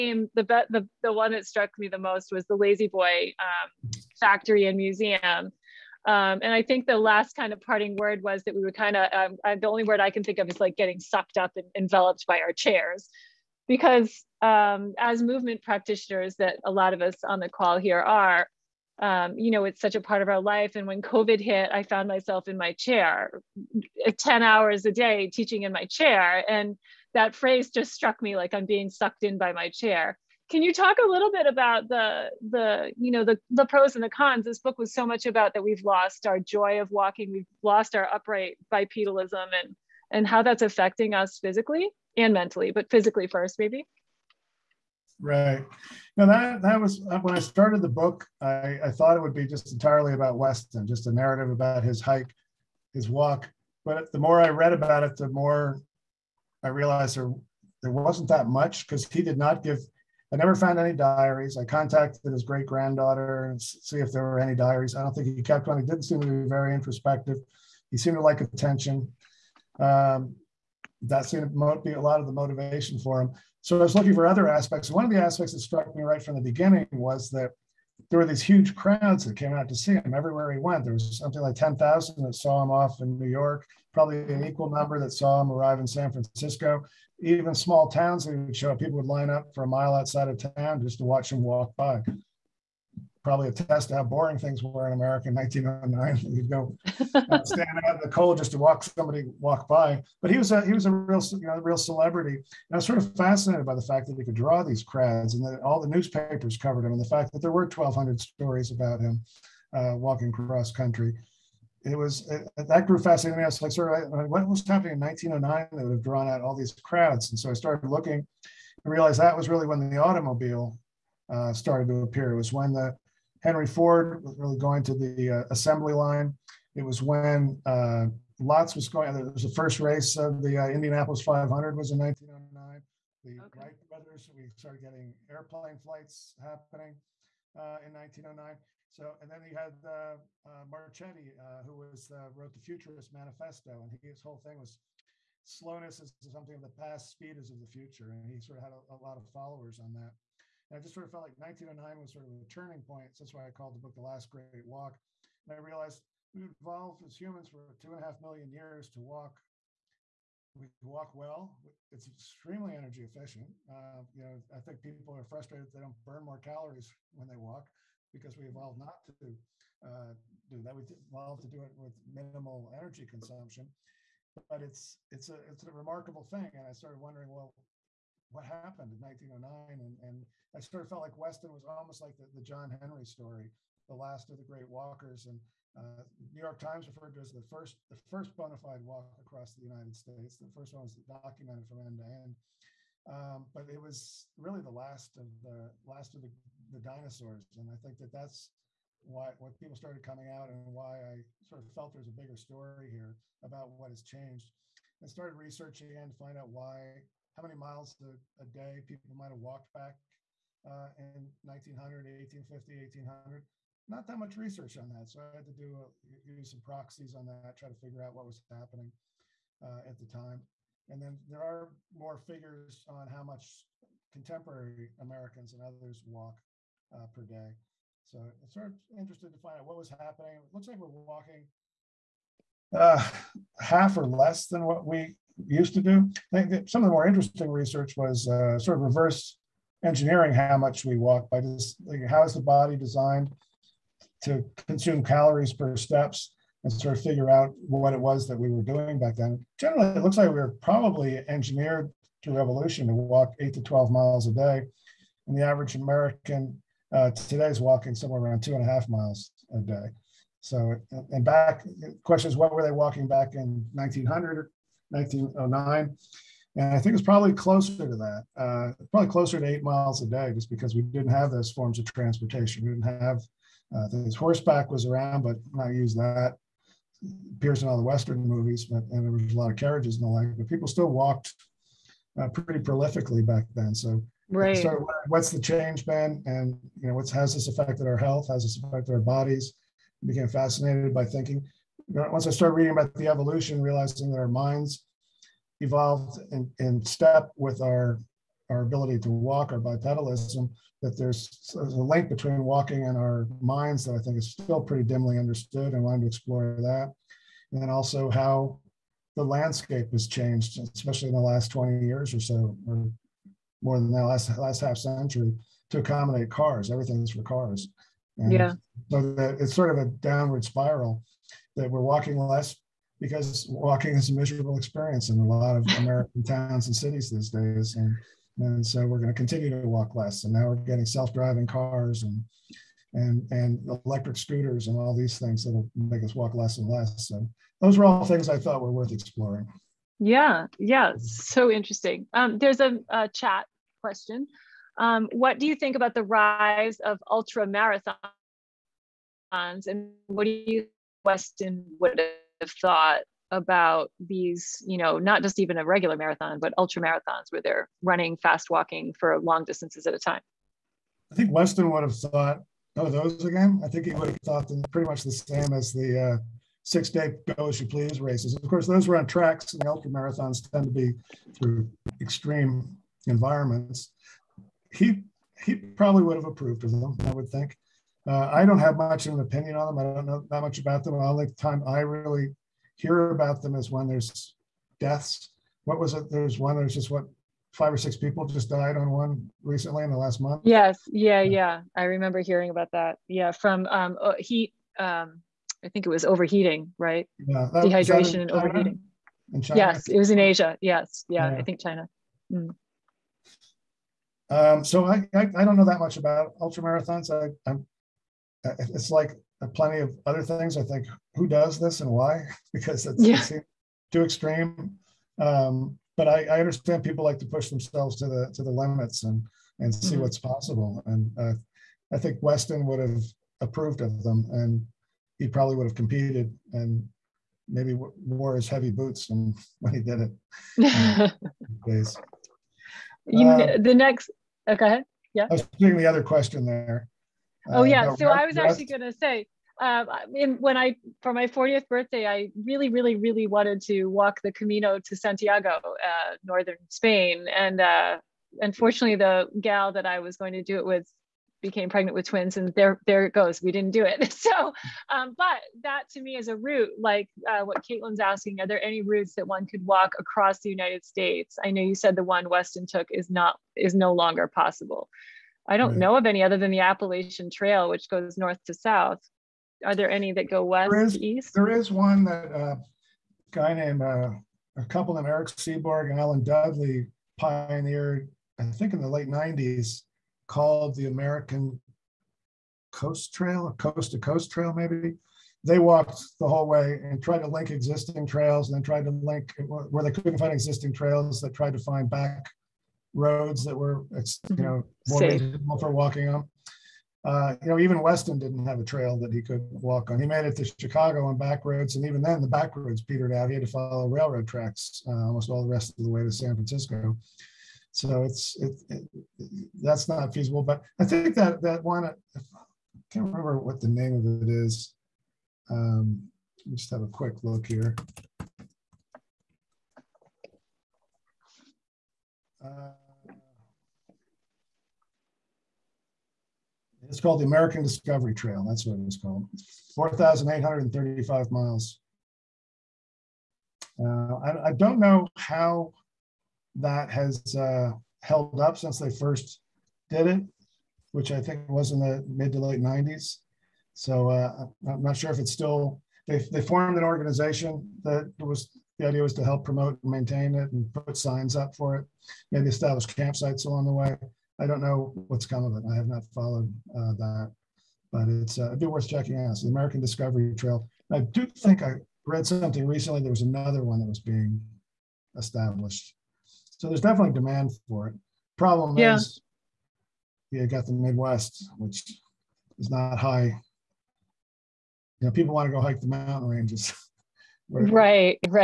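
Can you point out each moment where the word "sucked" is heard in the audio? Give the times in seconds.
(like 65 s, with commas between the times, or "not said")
10 s, 28 s.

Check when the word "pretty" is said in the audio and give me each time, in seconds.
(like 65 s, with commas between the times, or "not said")
282 s, 304 s, 364 s.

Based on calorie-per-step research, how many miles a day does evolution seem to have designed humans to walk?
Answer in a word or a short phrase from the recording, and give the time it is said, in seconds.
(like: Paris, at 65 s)
8 to 12 miles, at 253 s.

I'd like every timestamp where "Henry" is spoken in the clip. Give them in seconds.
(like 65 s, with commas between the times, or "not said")
123 s, 182 s.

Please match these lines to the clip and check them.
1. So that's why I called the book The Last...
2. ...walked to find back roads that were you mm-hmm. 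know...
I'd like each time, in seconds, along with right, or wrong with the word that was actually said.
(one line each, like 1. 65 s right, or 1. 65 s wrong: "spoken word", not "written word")
1. 153 s right
2. 491 s wrong: "tried", not "walked".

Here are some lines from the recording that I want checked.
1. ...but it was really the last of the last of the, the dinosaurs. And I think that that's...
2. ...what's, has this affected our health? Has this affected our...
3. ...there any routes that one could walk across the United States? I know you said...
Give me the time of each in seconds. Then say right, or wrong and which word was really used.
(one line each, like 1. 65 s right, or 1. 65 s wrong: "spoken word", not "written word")
1. 193 s right
2. 286 s right
3. 458 s right.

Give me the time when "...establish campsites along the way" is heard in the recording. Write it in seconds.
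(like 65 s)
552 s.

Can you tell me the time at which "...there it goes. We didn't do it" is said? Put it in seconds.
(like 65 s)
452 s.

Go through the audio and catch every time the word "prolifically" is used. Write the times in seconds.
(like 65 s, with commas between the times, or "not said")
282 s.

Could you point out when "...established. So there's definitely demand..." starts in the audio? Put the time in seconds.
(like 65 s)
565 s.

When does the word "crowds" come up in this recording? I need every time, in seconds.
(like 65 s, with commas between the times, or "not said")
78 s, 104 s, 116 s.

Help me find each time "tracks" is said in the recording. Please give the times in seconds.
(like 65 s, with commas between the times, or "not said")
369 s, 504 s.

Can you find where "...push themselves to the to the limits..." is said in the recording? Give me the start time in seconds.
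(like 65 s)
417 s.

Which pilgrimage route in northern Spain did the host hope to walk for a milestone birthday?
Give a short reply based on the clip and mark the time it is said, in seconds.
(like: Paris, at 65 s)
Camino to Santiago, at 444 s.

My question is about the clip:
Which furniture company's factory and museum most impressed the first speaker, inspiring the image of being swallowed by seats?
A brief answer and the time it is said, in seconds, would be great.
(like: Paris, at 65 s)
La-Z-Boy, at 2 s.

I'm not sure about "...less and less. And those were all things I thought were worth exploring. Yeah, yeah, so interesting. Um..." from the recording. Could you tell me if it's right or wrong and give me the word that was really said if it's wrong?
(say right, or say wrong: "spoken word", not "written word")
right.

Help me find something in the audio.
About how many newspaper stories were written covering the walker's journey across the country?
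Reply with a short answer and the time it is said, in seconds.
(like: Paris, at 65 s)
1,200, at 107 s.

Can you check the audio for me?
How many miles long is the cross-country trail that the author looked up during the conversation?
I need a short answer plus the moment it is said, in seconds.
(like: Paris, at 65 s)
4,835, at 529 s.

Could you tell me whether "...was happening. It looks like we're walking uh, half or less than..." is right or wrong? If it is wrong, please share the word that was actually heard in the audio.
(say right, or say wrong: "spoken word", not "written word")
right.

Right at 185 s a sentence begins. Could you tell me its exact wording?
And uh, New York Times referred to as the first, the first bona fide walk across the United States.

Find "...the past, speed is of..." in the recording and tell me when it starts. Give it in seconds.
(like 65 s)
146 s.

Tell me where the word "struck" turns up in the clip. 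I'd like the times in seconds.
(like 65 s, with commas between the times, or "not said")
1 s, 27 s, 75 s.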